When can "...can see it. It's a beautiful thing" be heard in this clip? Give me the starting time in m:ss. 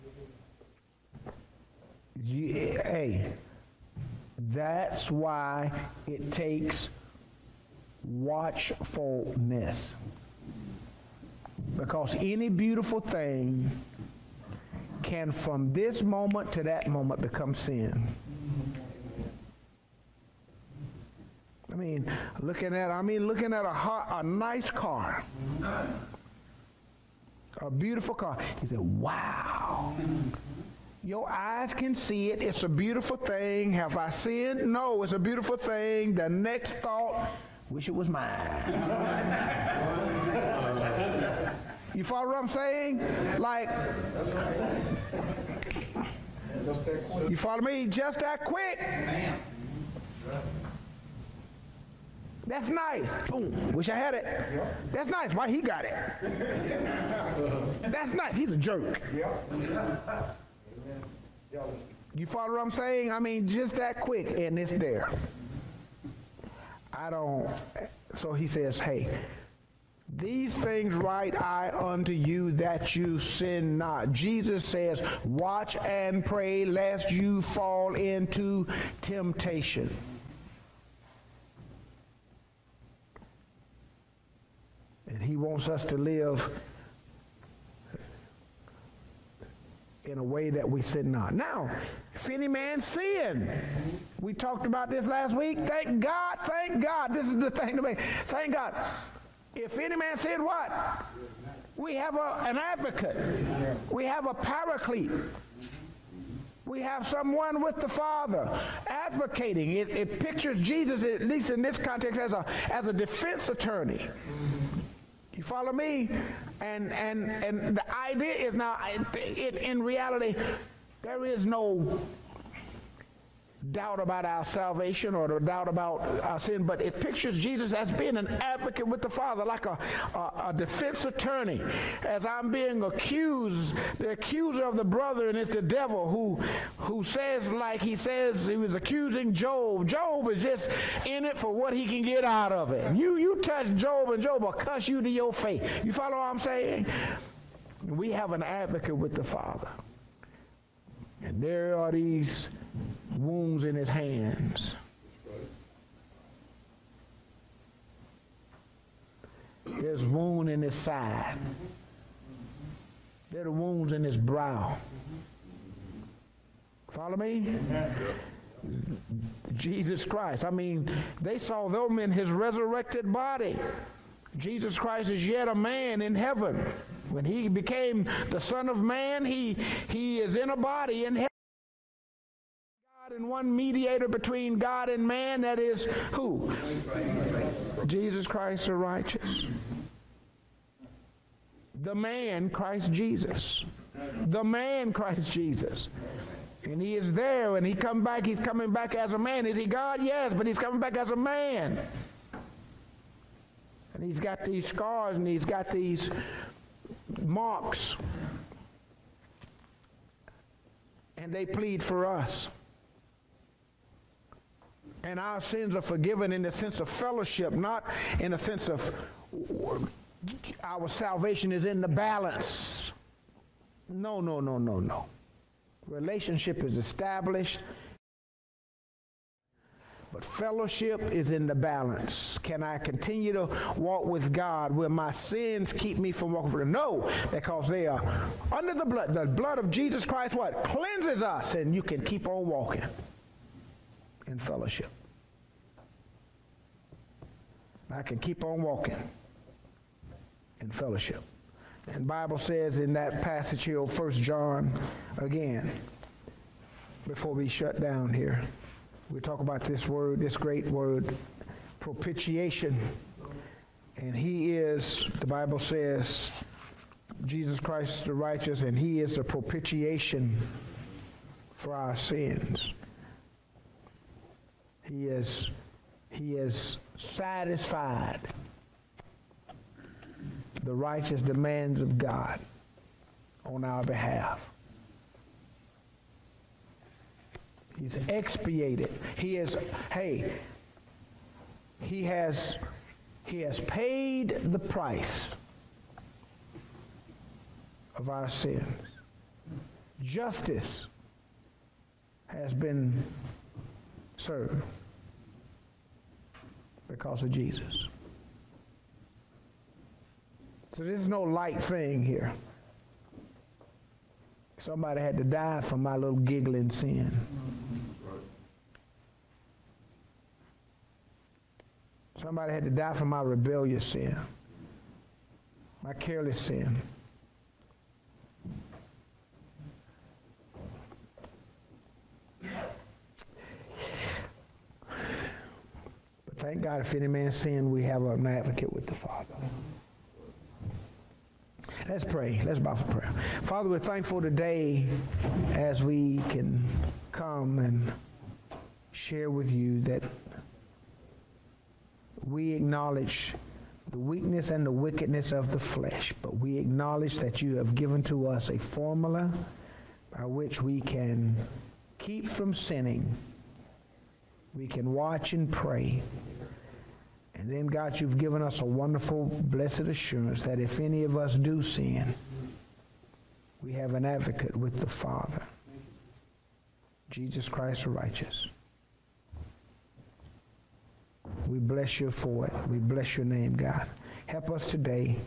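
0:31.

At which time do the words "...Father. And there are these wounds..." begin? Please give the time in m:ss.
2:29.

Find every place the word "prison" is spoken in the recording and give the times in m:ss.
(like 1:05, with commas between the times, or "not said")
not said.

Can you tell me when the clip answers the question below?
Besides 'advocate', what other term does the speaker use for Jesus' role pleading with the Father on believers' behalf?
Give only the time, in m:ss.
1:44.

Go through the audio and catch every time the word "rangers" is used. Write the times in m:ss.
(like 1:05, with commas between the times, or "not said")
not said.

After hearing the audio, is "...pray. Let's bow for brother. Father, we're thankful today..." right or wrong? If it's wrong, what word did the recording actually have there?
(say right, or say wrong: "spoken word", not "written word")
wrong: "prayer", not "brother".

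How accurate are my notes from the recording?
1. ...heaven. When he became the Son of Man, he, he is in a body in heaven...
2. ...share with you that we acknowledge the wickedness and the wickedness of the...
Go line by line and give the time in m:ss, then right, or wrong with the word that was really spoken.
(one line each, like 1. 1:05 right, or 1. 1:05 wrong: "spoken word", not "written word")
1. 2:56 right
2. 5:48 wrong: "weakness", not "wickedness".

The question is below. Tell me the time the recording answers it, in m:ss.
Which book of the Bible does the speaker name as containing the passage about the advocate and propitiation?
4:13.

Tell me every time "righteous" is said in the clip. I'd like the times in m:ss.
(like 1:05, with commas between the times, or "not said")
3:08, 4:28, 4:40, 6:17.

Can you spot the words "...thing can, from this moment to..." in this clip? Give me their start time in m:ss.
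0:12.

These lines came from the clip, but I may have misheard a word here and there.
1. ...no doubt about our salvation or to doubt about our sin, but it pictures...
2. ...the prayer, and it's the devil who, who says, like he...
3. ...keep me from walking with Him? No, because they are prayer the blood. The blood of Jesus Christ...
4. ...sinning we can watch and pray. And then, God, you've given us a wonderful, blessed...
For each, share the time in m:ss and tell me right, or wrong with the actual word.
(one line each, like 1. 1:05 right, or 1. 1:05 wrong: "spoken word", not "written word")
1. 2:01 right
2. 2:14 wrong: "brother", not "prayer"
3. 3:55 wrong: "under", not "prayer"
4. 6:02 right.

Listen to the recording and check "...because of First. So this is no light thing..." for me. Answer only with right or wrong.
wrong.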